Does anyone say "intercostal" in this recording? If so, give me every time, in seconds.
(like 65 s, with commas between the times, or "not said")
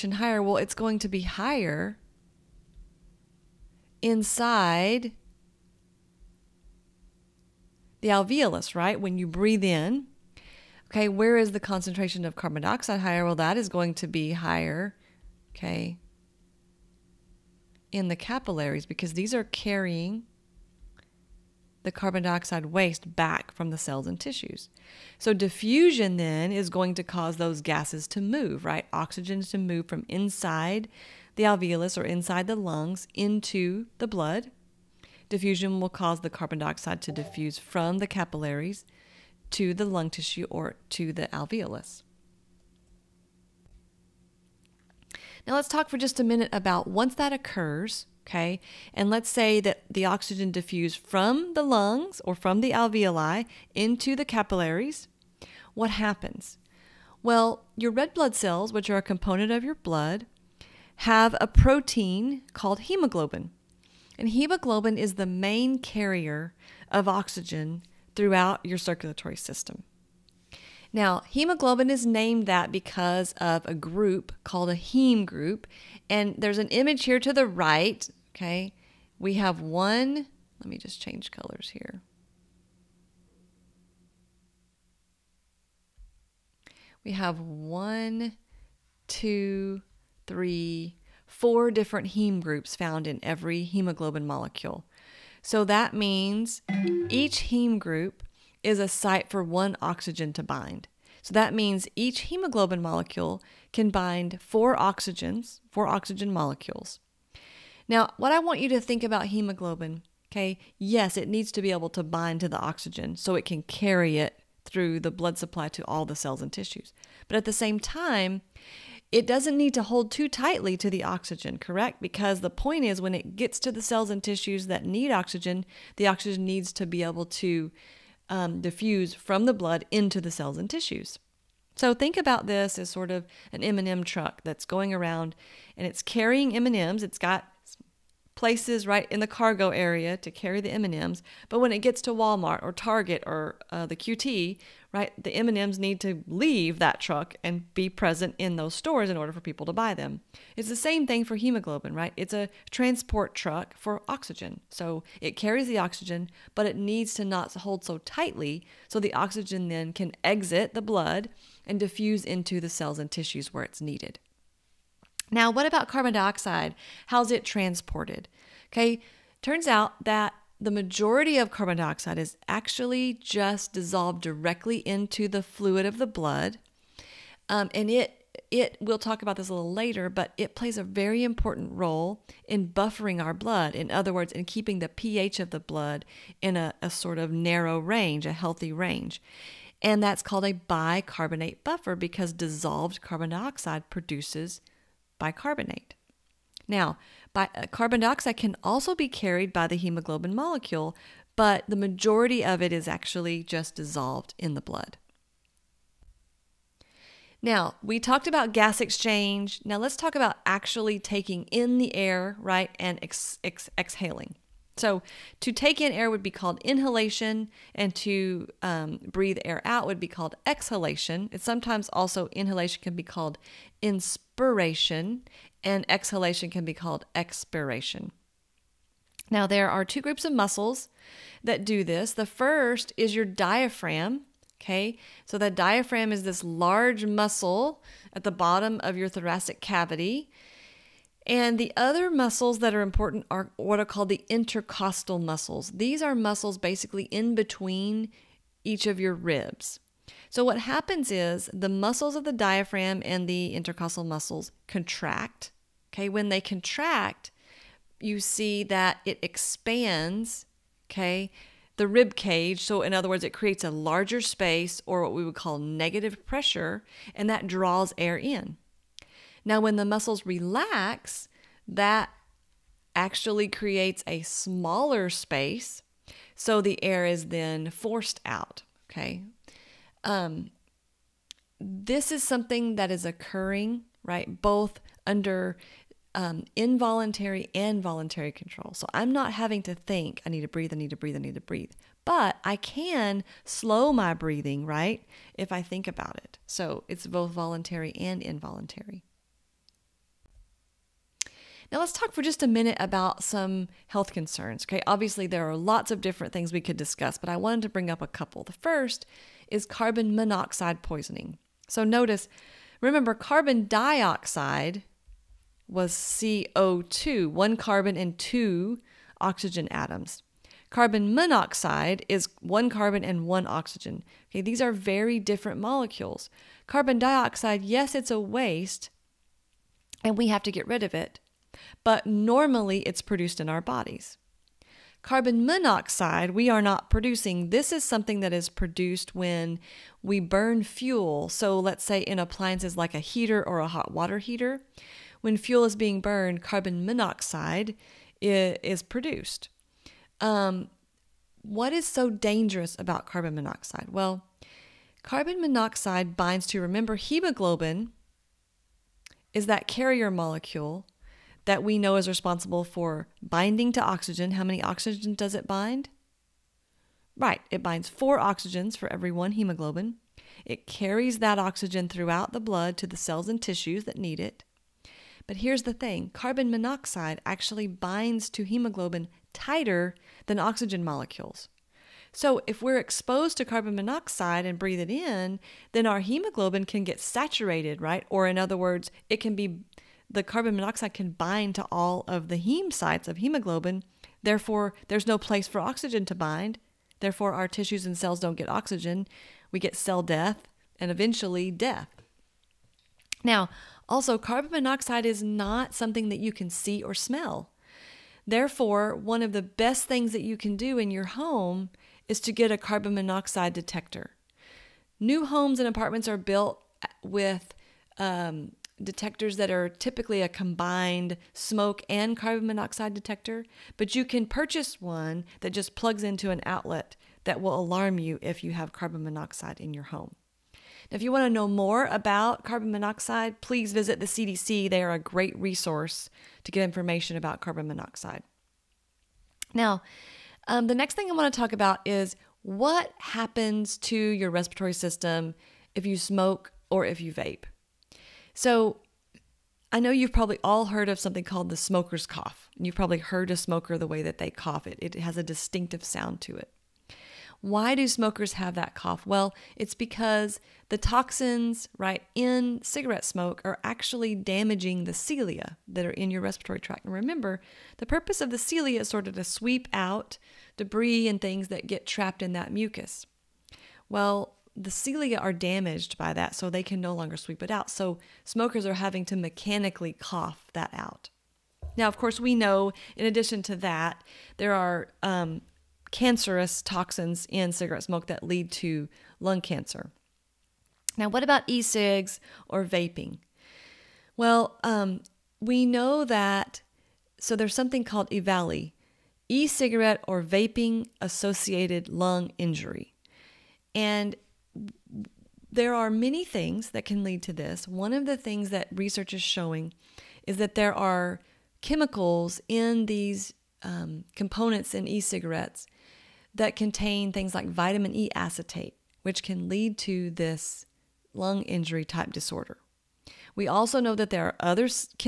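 244 s, 253 s.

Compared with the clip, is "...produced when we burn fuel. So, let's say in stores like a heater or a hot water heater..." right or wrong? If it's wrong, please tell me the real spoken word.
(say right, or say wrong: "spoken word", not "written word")
wrong: "appliances", not "stores".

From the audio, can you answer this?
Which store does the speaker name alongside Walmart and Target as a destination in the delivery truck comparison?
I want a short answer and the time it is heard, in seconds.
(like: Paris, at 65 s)
QT, at 143 s.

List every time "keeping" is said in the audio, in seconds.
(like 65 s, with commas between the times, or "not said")
184 s.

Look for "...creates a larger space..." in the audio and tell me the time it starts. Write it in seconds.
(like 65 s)
263 s.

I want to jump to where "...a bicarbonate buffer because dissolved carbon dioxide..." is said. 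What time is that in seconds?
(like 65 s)
190 s.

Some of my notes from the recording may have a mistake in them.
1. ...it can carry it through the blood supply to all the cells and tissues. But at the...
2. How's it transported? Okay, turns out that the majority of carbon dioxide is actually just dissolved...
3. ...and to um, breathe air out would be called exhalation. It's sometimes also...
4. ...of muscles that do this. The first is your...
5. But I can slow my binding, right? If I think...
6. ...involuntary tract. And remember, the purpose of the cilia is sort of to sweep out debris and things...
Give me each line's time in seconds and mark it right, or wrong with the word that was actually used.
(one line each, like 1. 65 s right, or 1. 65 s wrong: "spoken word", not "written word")
1. 113 s right
2. 167 s right
3. 217 s right
4. 230 s right
5. 292 s wrong: "breathing", not "binding"
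6. 466 s wrong: "respiratory", not "involuntary".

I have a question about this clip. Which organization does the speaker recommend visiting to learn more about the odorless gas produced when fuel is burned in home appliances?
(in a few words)
CDC.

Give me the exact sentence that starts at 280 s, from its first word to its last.
Um, this is something that is occurring, right?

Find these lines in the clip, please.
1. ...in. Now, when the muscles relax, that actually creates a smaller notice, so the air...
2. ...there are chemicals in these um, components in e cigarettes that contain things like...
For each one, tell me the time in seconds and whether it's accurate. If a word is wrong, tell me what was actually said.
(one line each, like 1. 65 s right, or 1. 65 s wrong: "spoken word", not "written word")
1. 268 s wrong: "space", not "notice"
2. 510 s right.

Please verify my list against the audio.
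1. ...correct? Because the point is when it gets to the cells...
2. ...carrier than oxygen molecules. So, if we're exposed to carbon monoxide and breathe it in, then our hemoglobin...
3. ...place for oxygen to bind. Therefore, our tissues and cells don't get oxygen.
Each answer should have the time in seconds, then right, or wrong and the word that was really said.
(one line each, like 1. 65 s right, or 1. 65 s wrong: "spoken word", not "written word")
1. 121 s right
2. 379 s wrong: "tighter", not "carrier"
3. 395 s right.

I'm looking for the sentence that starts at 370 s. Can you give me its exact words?
It carries that oxygen throughout the blood to the cells and tissues that need it.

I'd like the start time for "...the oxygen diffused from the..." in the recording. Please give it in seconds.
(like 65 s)
49 s.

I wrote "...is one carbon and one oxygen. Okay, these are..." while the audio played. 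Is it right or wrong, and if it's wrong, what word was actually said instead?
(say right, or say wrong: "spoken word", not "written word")
right.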